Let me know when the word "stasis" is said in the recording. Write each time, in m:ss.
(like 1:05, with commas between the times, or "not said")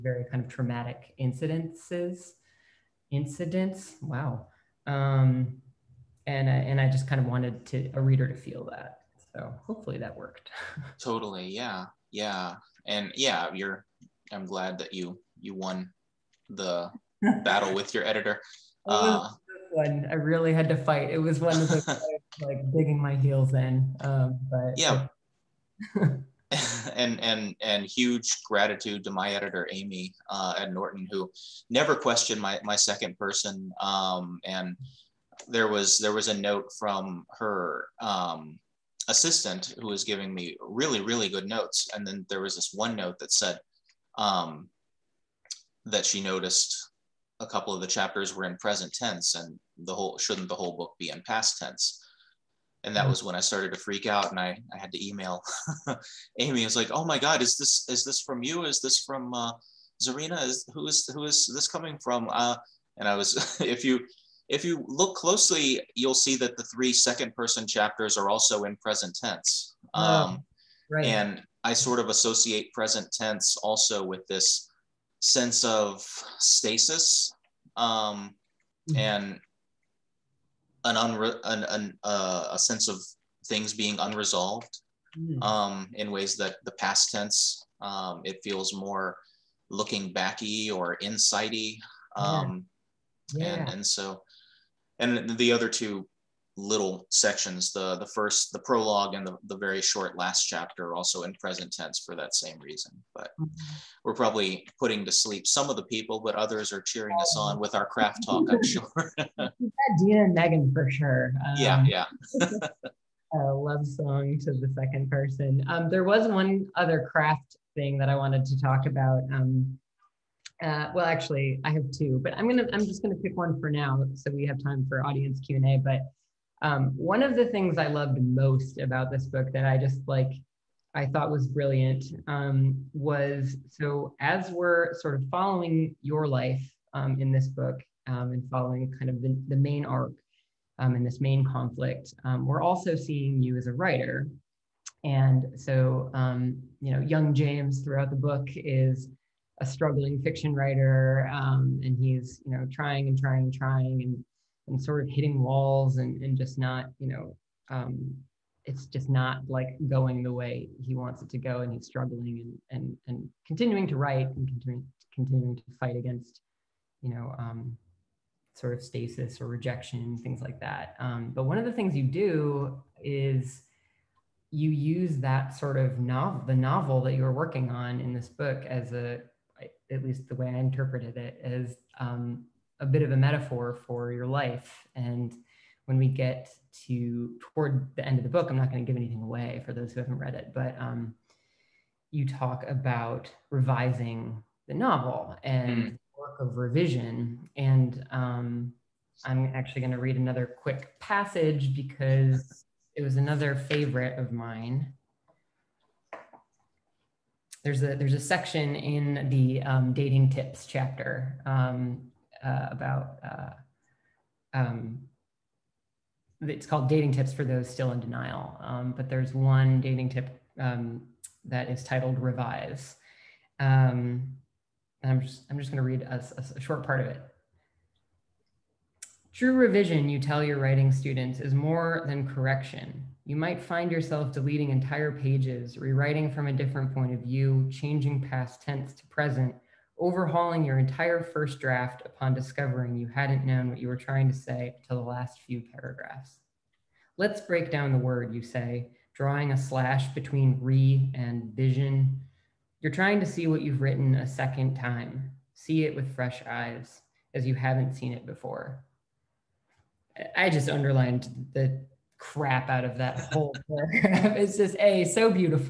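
1:16, 2:48.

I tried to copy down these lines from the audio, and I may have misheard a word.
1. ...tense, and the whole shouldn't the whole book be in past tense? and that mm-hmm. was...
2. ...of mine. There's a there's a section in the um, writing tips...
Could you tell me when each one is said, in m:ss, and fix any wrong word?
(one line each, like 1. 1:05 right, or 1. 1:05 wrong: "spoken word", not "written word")
1. 0:48 right
2. 3:24 wrong: "dating", not "writing".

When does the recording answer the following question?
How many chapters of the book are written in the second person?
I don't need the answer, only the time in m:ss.
1:06.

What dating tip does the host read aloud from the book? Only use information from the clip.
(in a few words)
Revise.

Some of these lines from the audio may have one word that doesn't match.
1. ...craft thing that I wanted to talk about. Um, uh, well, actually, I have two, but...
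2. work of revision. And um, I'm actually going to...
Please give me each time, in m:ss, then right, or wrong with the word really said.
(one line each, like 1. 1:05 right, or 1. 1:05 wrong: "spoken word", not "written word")
1. 1:57 right
2. 3:16 right.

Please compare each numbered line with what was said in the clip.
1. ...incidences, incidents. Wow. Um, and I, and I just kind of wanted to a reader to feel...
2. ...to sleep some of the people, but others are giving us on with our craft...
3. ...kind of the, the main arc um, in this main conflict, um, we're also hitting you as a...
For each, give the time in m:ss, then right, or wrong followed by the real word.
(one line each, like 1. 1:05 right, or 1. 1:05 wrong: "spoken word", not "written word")
1. 0:01 right
2. 1:45 wrong: "cheering", not "giving"
3. 2:18 wrong: "seeing", not "hitting".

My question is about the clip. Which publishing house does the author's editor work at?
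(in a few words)
Norton.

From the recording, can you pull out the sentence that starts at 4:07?
Let's break down the word, you say, drawing a slash between re and vision.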